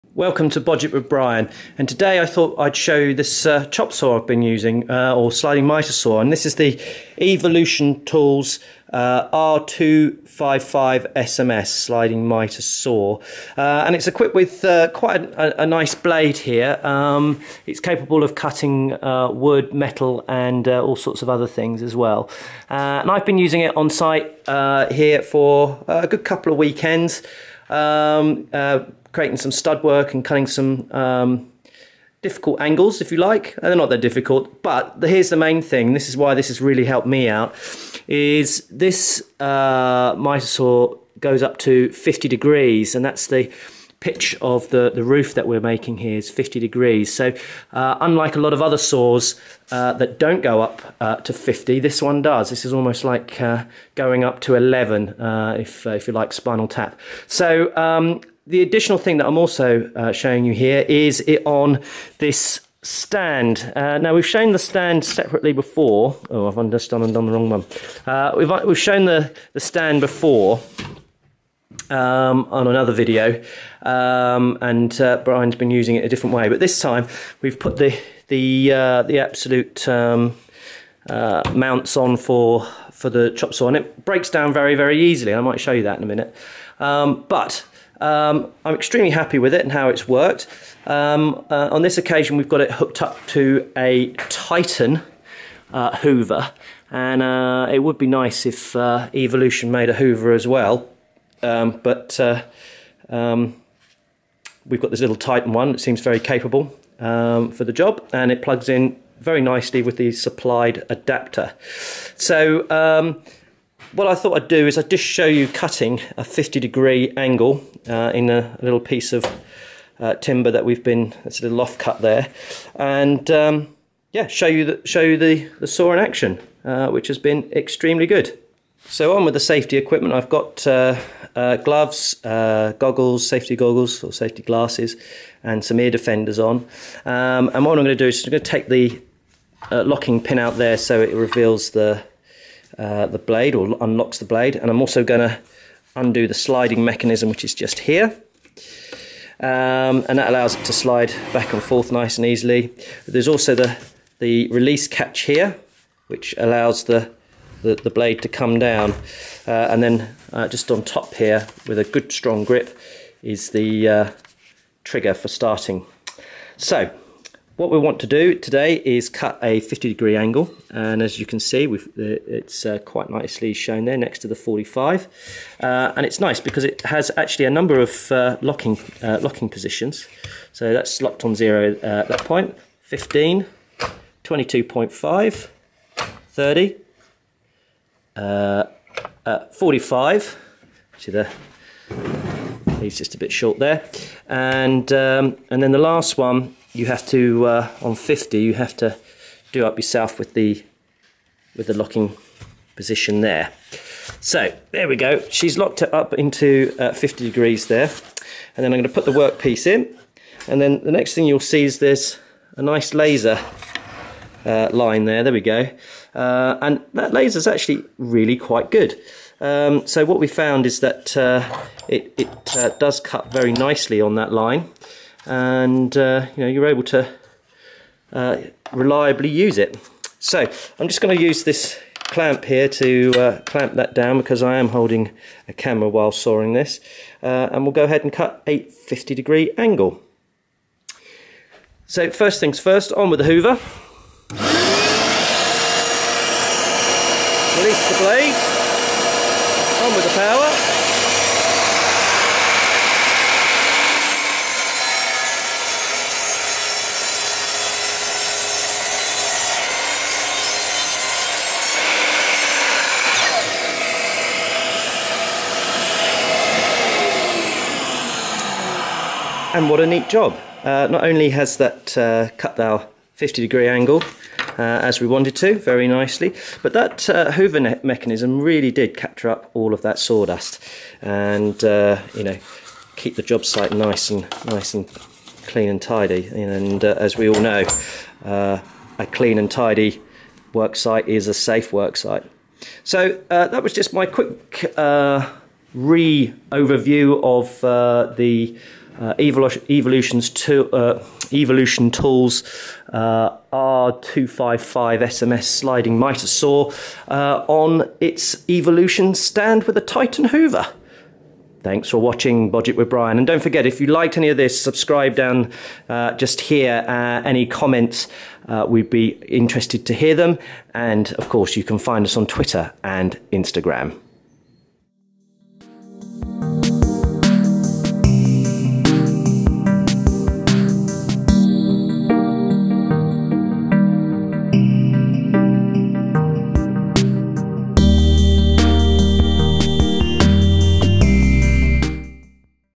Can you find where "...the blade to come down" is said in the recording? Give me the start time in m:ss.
2:37.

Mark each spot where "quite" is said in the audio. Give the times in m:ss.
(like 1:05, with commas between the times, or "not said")
0:14, 2:52, 3:38.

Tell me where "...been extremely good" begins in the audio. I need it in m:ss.
2:07.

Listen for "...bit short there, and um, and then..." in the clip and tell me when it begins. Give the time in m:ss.
3:13.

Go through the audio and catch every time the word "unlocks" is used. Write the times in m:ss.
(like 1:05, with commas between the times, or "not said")
2:23.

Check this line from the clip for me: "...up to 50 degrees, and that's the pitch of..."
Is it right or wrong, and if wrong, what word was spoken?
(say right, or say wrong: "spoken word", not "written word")
right.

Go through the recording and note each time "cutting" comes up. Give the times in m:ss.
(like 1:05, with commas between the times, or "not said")
0:18, 0:30, 1:55.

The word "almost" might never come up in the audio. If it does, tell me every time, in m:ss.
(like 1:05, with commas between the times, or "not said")
0:52.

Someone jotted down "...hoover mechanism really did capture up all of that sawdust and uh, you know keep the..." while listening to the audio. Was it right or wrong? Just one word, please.
right.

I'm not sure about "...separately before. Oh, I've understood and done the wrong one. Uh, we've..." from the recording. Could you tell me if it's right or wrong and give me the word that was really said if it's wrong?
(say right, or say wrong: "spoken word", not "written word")
right.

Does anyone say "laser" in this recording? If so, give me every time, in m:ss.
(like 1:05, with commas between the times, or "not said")
3:32, 3:37.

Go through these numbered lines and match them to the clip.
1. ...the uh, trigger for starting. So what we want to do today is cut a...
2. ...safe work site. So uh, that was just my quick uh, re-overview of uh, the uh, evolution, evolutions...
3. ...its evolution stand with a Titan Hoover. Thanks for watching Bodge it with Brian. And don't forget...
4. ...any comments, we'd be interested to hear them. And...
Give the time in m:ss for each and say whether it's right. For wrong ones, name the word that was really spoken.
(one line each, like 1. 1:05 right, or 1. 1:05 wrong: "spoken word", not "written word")
1. 2:43 right
2. 4:51 right
3. 5:08 right
4. 5:17 right.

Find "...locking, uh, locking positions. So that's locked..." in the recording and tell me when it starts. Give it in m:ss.
2:58.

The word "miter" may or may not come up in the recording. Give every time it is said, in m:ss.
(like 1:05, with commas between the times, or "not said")
0:40, 5:05.